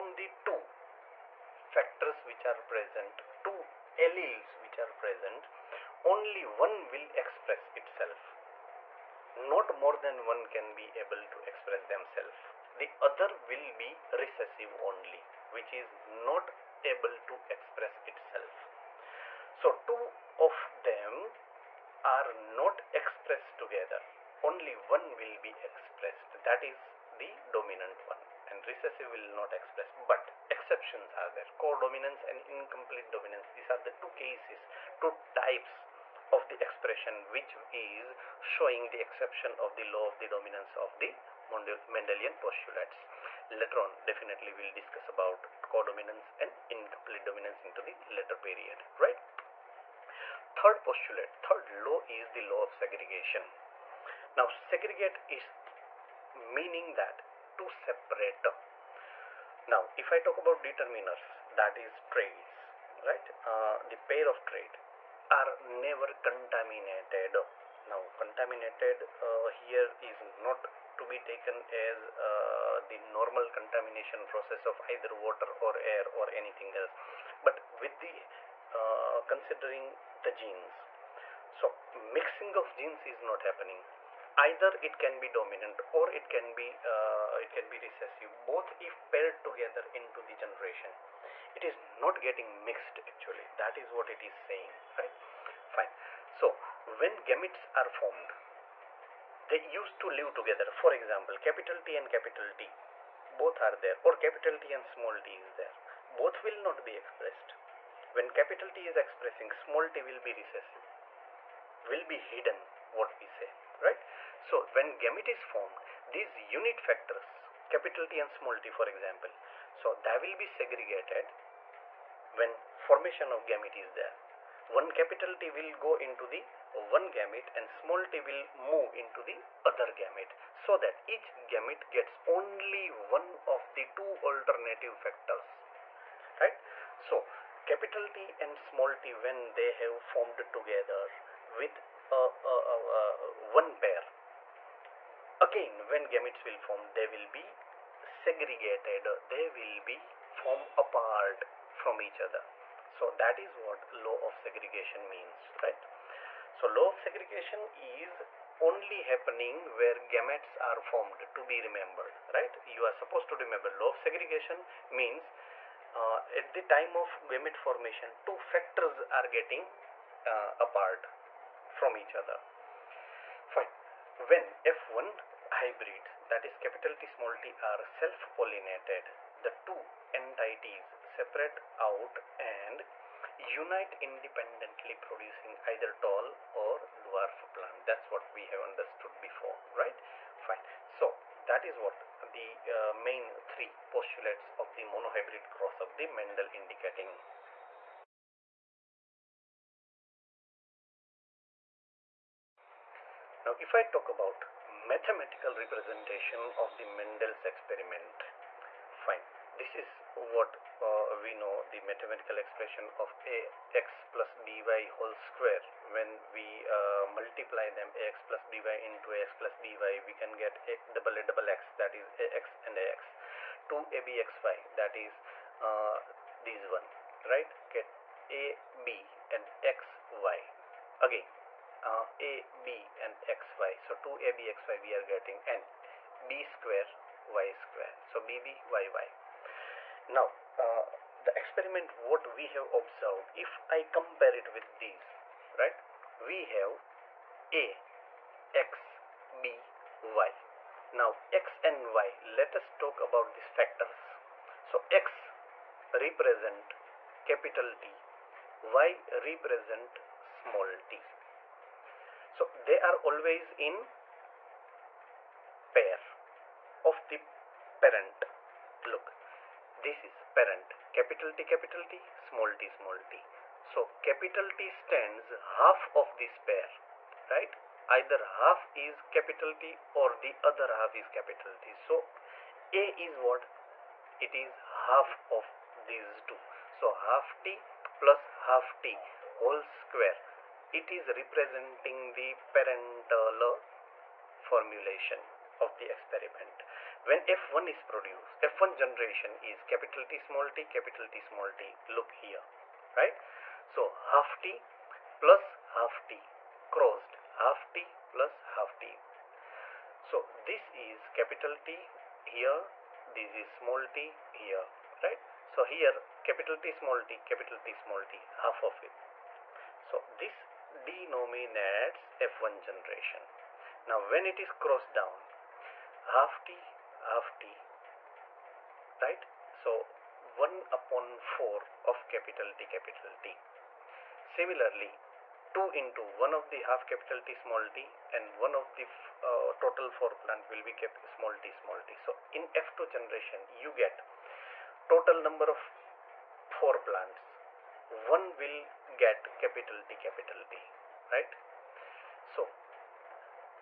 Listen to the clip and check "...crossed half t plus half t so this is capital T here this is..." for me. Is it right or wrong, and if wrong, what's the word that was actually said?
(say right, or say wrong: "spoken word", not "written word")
right.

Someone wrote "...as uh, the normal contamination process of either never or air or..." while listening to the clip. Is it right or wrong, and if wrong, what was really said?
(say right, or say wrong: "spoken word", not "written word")
wrong: "water", not "never".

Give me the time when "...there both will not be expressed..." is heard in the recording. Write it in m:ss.
1:45.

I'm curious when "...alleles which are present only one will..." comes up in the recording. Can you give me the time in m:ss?
0:03.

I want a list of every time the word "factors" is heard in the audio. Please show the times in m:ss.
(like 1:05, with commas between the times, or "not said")
0:01, 1:56, 2:14, 2:48, 4:13.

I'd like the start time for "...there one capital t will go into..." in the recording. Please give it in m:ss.
2:03.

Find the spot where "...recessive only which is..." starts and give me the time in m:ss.
0:14.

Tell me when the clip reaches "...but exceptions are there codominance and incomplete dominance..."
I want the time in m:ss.
0:29.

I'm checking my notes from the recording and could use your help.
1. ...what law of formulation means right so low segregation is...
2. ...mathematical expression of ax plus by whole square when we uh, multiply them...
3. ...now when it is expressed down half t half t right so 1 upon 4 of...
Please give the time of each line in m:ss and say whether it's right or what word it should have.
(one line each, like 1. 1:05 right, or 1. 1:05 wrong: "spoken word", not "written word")
1. 2:33 wrong: "segregation", not "formulation"
2. 3:31 right
3. 5:23 wrong: "crossed", not "expressed".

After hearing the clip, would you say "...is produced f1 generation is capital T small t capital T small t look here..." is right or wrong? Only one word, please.
right.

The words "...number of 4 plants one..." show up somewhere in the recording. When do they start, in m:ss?
5:45.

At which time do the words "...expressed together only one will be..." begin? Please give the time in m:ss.
0:22.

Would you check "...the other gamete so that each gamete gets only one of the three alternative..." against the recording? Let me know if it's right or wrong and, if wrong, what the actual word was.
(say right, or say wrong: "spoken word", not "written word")
wrong: "two", not "three".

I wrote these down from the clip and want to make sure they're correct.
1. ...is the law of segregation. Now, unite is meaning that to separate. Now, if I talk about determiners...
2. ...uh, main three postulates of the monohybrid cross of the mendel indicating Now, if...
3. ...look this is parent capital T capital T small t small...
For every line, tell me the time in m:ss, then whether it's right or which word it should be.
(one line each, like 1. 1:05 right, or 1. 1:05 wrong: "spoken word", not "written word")
1. 0:52 wrong: "segregate", not "unite"
2. 3:12 right
3. 4:28 right.